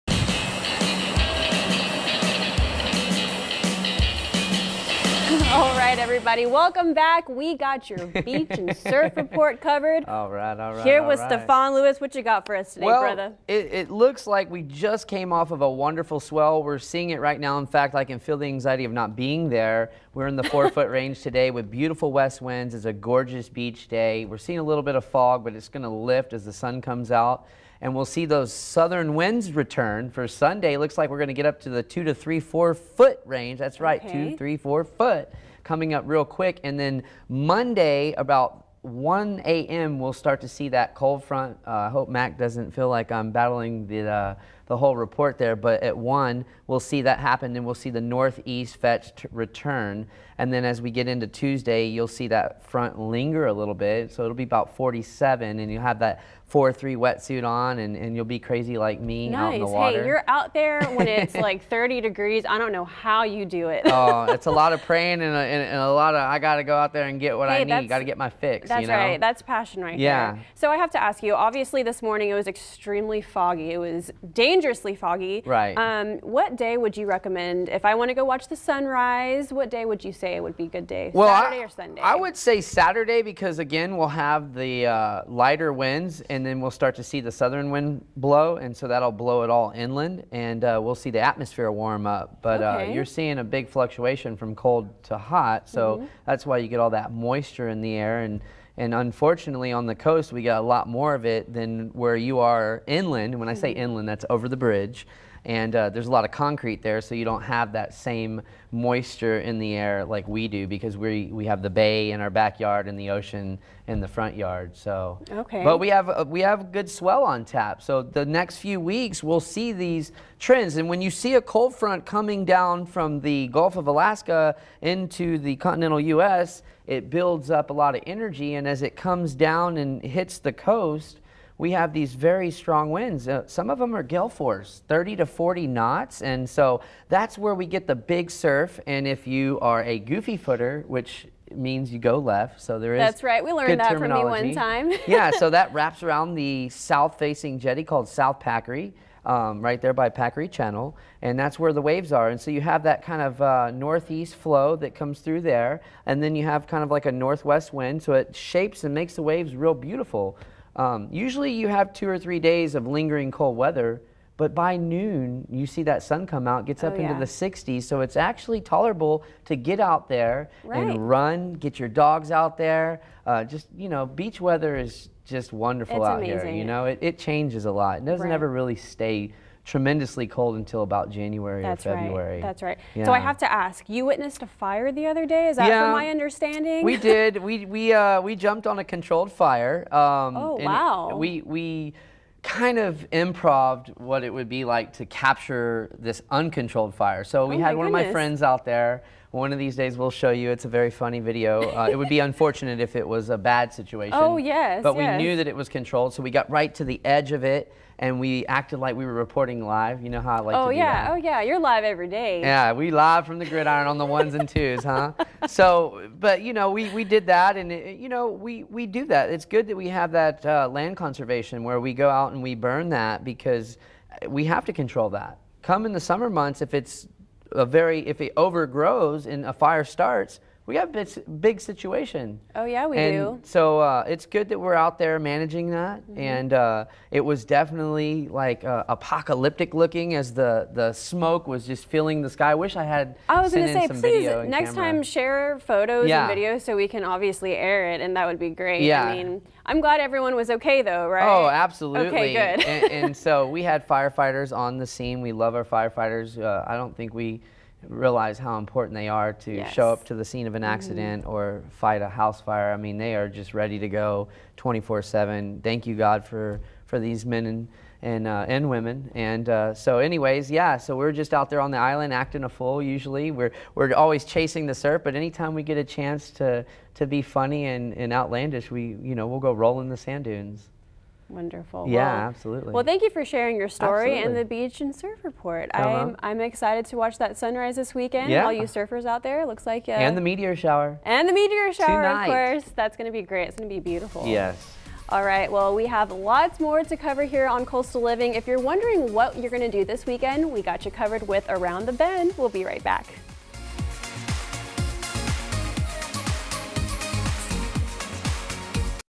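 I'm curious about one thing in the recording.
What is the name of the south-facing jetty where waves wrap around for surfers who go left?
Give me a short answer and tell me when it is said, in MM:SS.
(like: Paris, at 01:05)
South Packery, at 02:28.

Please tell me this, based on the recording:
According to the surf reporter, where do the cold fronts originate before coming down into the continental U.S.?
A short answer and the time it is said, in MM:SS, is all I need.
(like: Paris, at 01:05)
Gulf of Alaska, at 02:03.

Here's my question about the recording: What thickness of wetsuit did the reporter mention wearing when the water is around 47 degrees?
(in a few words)
4-3.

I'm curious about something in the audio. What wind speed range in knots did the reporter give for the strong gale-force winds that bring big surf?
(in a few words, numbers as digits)
30 to 40 knots.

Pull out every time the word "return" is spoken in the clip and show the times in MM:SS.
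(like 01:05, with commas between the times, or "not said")
00:29, 00:49.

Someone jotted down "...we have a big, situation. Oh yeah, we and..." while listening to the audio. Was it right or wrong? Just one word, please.
right.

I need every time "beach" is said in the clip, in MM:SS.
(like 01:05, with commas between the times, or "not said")
00:08, 00:23, 02:54, 04:44.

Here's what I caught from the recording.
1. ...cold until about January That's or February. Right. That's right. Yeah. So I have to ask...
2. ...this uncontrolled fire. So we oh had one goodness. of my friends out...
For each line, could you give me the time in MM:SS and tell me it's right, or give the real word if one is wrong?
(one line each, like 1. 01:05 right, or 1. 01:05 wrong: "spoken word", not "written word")
1. 03:00 right
2. 03:15 right.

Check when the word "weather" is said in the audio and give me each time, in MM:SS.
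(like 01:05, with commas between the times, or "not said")
02:43, 02:54.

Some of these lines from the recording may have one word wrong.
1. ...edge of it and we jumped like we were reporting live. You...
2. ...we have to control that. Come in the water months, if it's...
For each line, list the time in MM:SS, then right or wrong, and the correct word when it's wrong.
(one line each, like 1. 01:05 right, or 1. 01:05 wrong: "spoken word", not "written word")
1. 03:27 wrong: "acted", not "jumped"
2. 03:44 wrong: "summer", not "water".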